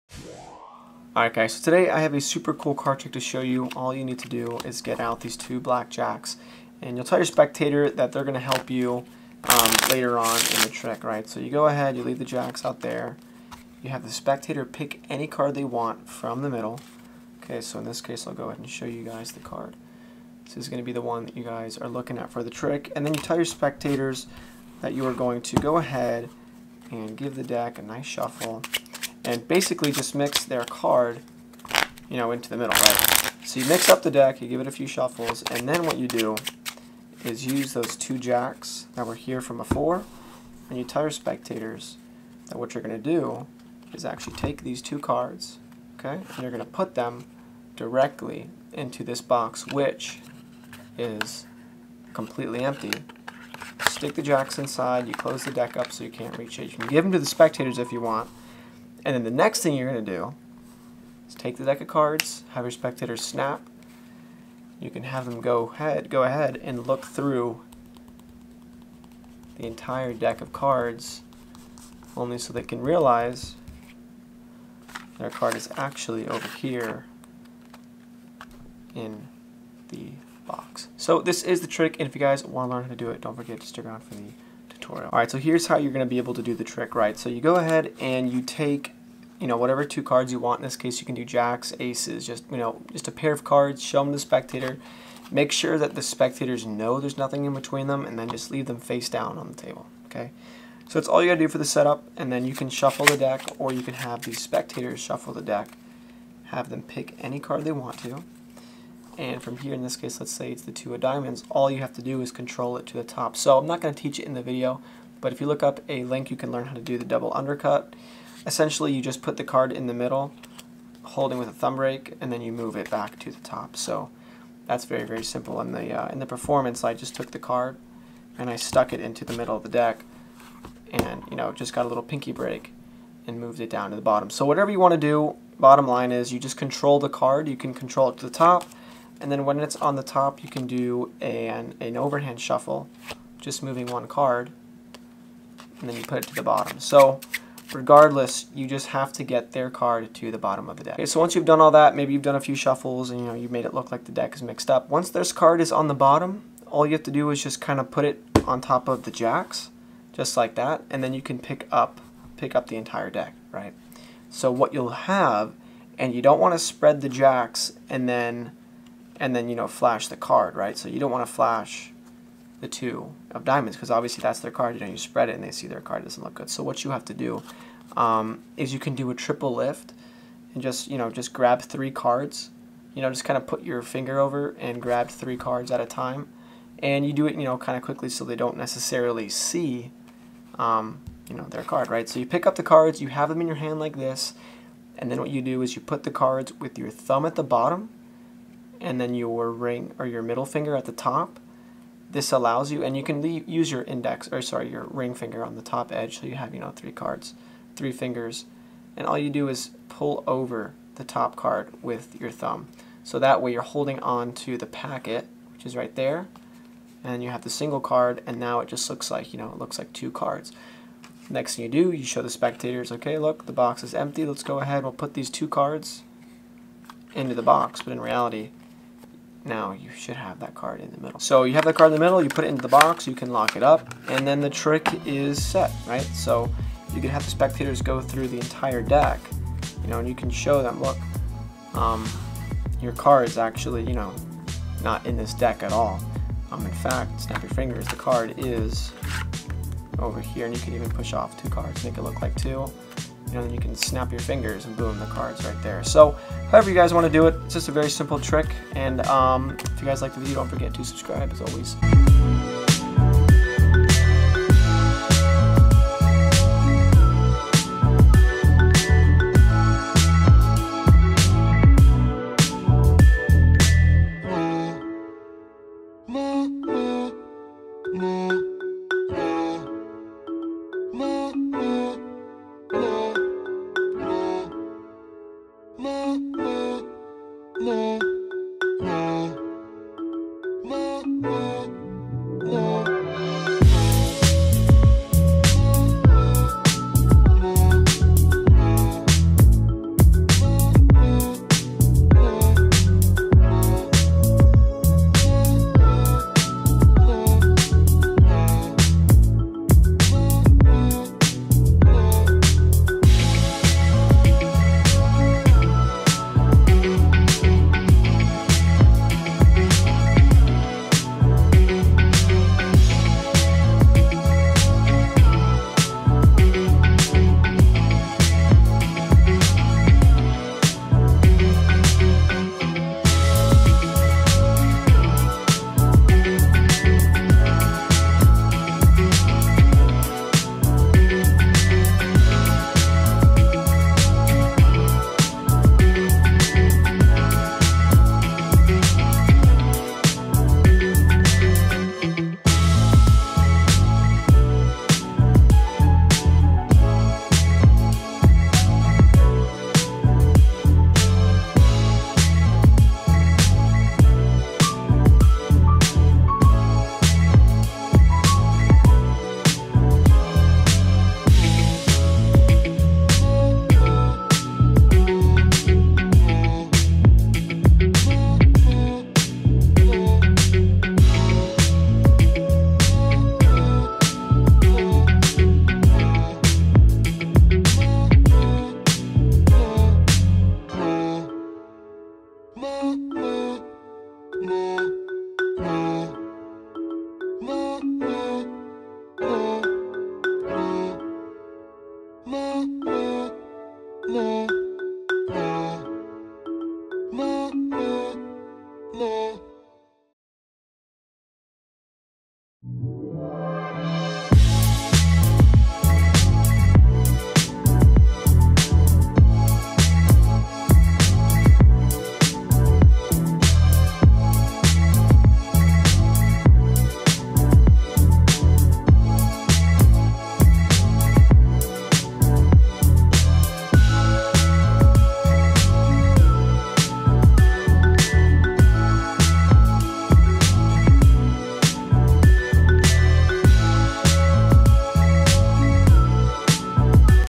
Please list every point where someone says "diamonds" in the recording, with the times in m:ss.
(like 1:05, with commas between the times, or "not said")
1:50, 2:53.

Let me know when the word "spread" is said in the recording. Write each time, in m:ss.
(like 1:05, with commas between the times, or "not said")
2:46, 2:54.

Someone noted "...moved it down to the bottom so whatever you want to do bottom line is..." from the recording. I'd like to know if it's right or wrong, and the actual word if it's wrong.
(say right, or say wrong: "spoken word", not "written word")
right.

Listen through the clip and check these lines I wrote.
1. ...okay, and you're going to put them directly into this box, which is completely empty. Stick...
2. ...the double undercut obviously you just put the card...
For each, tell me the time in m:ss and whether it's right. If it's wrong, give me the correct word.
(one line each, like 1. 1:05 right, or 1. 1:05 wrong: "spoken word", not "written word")
1. 0:45 right
2. 1:56 wrong: "essentially", not "obviously".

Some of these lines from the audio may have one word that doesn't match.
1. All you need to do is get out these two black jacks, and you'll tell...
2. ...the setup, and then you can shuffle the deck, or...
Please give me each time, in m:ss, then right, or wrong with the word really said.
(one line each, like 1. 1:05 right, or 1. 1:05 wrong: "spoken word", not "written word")
1. 0:03 right
2. 1:41 right.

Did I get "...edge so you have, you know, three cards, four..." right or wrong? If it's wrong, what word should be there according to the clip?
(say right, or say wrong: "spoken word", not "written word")
wrong: "three", not "four".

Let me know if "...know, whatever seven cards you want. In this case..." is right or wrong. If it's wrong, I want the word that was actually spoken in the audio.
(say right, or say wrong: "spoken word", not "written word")
wrong: "two", not "seven".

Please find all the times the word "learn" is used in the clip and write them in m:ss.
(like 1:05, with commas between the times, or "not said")
1:22, 1:56.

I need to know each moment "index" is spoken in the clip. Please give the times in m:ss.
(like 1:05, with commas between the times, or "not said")
3:23.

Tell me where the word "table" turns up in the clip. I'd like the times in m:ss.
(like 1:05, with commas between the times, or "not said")
1:39.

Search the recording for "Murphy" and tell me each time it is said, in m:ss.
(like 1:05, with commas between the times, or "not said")
not said.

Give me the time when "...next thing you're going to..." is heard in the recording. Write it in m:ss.
0:59.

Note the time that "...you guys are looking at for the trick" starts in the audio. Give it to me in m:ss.
0:21.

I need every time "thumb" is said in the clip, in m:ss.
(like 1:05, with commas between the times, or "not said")
2:01, 3:16, 3:32.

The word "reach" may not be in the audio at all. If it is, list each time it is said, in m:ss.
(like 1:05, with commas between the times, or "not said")
0:56.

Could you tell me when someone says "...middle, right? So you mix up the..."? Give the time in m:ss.
0:32.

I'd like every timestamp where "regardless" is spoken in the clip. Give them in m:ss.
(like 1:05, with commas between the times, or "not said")
2:27.